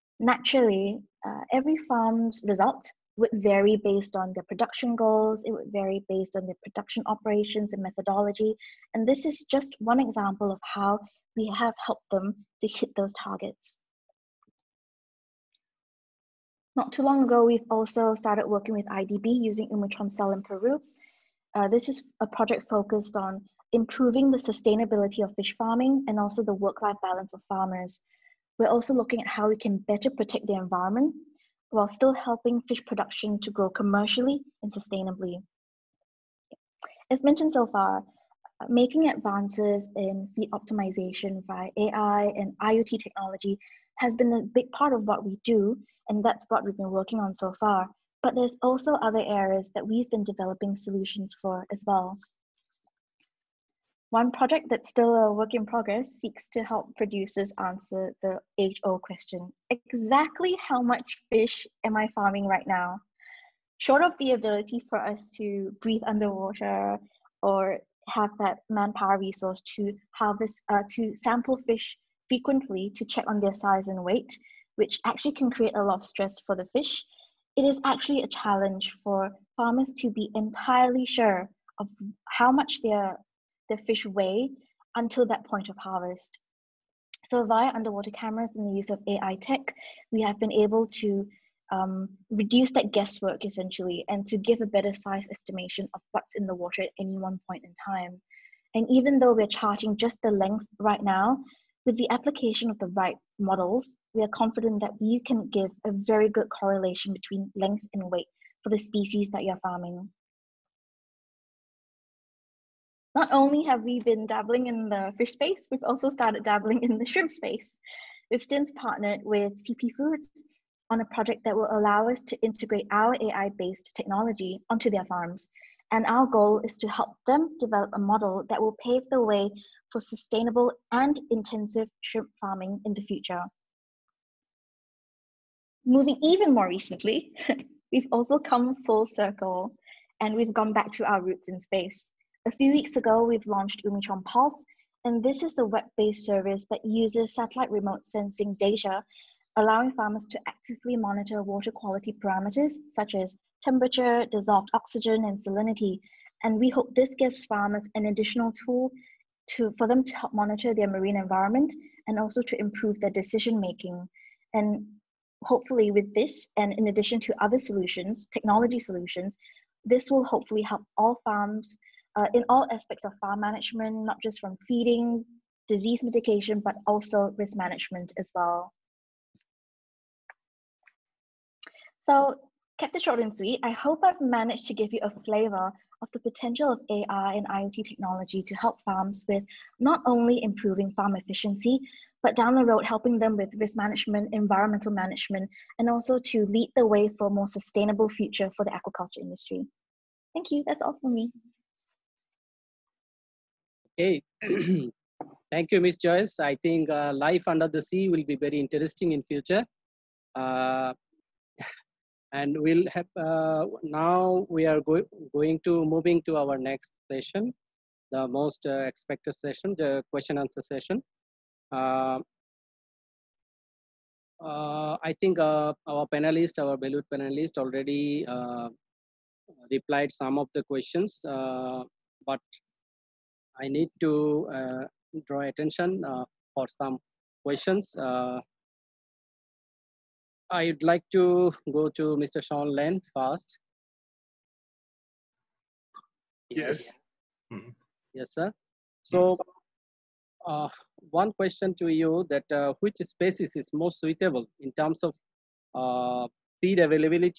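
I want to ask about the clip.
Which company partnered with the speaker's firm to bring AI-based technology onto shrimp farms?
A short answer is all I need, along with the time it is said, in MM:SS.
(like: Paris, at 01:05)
CP Foods, at 01:59.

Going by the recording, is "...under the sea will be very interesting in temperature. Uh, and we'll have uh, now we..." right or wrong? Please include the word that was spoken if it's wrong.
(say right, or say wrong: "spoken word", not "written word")
wrong: "future", not "temperature".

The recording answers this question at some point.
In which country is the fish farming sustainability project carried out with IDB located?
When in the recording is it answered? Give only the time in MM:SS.
00:20.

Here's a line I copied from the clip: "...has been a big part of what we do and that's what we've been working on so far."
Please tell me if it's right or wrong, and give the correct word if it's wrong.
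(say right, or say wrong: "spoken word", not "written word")
right.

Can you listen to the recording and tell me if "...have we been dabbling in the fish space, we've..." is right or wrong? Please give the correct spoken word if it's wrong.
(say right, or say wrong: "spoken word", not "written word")
right.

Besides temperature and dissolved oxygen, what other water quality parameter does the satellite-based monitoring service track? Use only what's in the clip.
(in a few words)
Salinity.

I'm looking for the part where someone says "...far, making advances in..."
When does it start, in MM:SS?
00:37.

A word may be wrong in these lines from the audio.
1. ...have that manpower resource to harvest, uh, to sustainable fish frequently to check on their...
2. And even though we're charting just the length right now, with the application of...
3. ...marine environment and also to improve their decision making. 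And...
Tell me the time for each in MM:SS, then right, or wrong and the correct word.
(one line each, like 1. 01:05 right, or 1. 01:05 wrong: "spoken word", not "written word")
1. 01:08 wrong: "sample", not "sustainable"
2. 01:38 right
3. 02:40 right.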